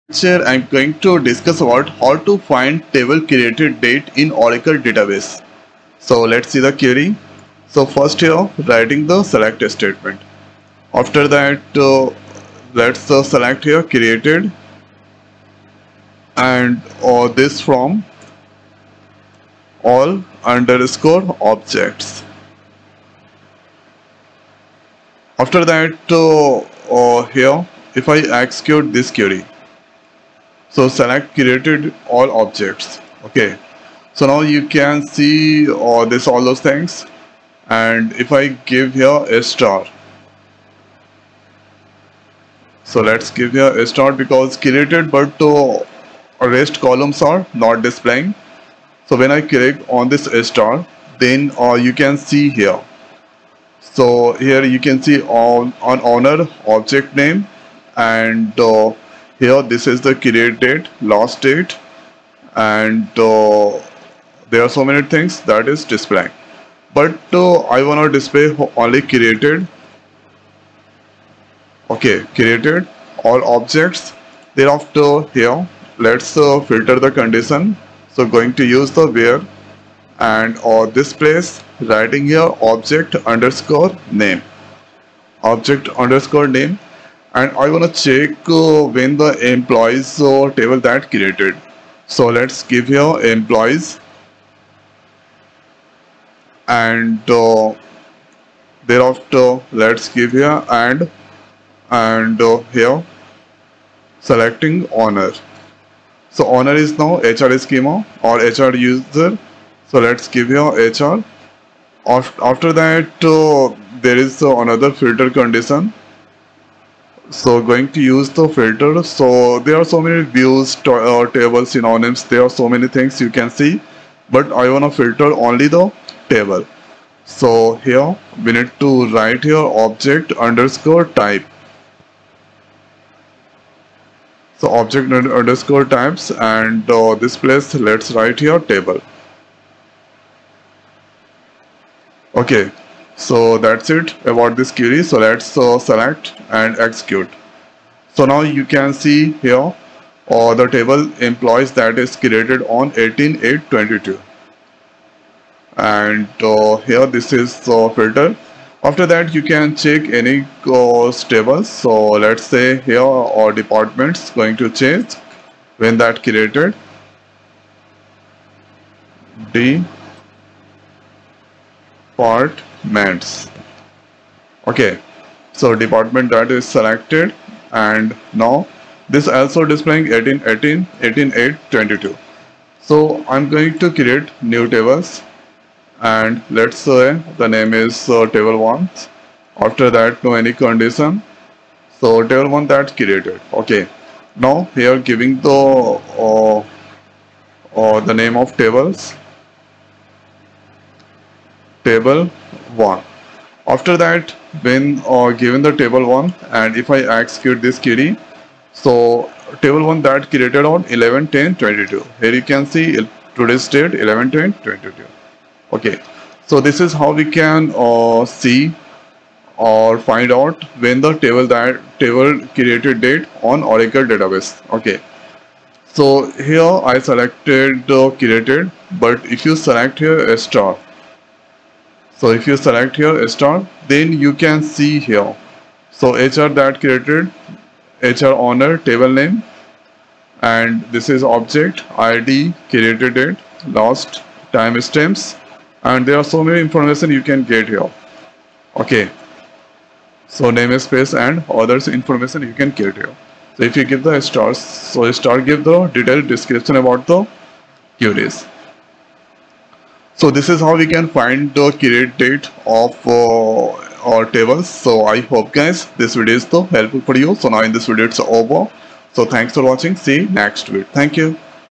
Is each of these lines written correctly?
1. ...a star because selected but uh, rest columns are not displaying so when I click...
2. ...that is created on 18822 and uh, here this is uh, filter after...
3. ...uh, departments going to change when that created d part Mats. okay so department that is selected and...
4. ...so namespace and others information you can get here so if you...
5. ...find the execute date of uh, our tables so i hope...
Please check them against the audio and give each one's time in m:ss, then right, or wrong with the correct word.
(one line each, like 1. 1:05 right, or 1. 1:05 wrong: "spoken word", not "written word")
1. 0:43 wrong: "created", not "selected"
2. 2:31 right
3. 2:43 right
4. 4:10 right
5. 4:21 wrong: "create", not "execute".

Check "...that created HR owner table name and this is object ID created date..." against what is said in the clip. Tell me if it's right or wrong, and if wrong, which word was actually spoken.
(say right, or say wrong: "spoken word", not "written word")
right.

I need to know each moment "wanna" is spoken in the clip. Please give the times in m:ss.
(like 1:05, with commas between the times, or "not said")
1:07, 1:27, 2:04.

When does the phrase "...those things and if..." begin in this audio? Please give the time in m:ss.
0:36.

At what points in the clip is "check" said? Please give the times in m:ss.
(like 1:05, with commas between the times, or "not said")
1:27, 2:39.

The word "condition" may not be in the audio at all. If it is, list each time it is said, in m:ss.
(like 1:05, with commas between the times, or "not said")
1:17, 1:55, 3:10.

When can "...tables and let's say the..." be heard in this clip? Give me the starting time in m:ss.
3:04.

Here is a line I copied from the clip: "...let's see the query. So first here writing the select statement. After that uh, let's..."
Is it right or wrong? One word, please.
right.